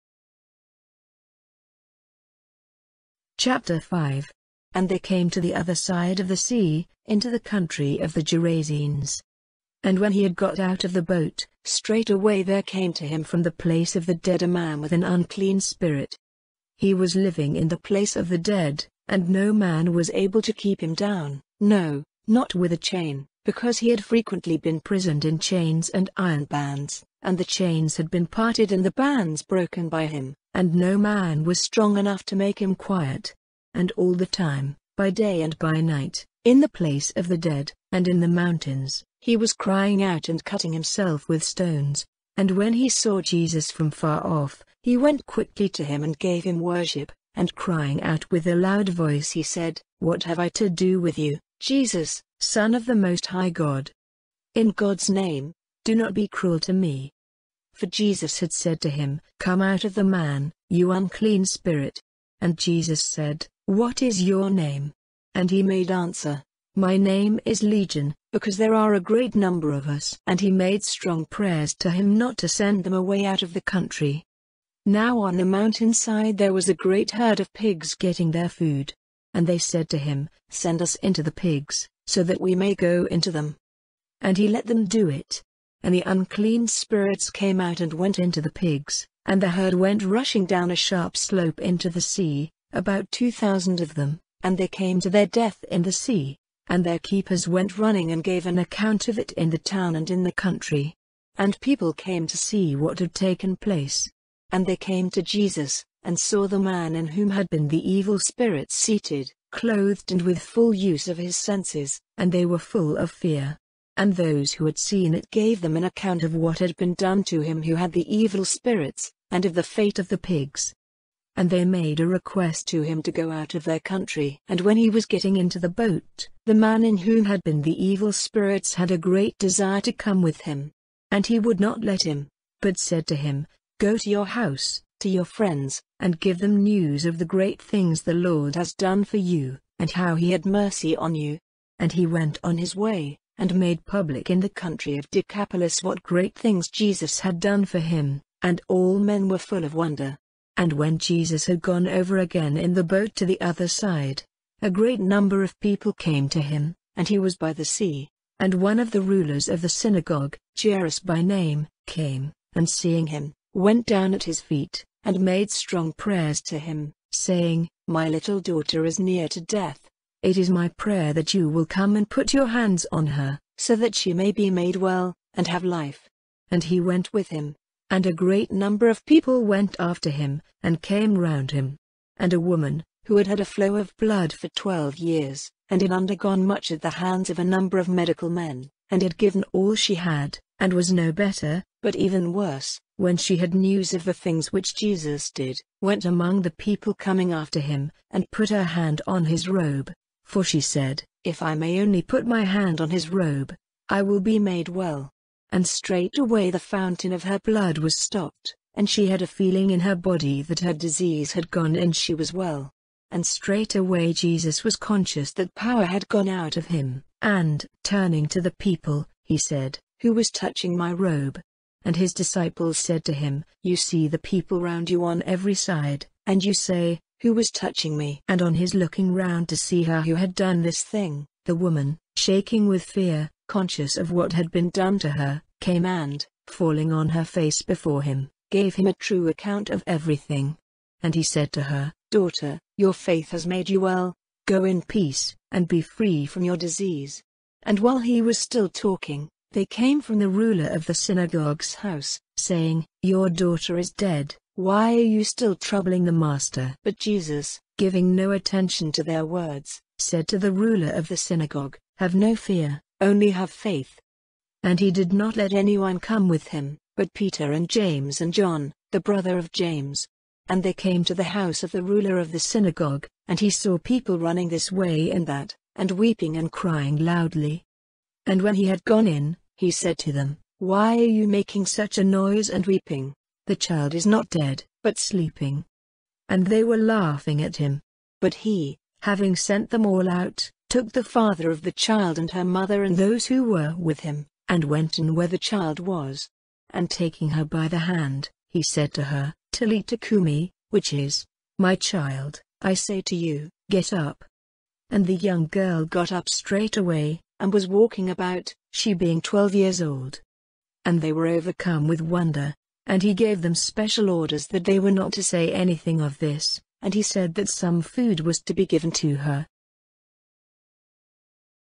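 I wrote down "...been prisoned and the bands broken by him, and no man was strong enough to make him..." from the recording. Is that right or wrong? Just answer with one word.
wrong.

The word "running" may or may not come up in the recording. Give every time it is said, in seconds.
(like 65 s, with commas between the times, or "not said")
97 s, 274 s.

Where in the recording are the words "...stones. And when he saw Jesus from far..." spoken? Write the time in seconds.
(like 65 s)
41 s.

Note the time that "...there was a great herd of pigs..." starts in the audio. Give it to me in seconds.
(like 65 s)
76 s.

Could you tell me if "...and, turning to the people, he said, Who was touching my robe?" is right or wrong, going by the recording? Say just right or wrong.
right.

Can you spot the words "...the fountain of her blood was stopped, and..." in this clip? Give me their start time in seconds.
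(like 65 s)
206 s.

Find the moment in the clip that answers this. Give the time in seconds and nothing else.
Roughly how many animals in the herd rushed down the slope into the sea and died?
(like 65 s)
93 s.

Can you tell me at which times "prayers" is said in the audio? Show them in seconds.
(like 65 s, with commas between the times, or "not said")
71 s, 165 s, 170 s.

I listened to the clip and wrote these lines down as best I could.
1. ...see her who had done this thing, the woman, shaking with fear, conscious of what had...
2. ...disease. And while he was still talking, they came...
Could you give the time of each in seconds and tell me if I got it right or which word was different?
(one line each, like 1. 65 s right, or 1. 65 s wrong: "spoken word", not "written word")
1. 229 s right
2. 246 s right.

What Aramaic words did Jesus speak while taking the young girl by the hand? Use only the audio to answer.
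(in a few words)
Talitha cumi.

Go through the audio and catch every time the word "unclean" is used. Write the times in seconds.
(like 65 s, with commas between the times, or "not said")
15 s, 60 s, 86 s.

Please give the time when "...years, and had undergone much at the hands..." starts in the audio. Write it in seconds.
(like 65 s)
184 s.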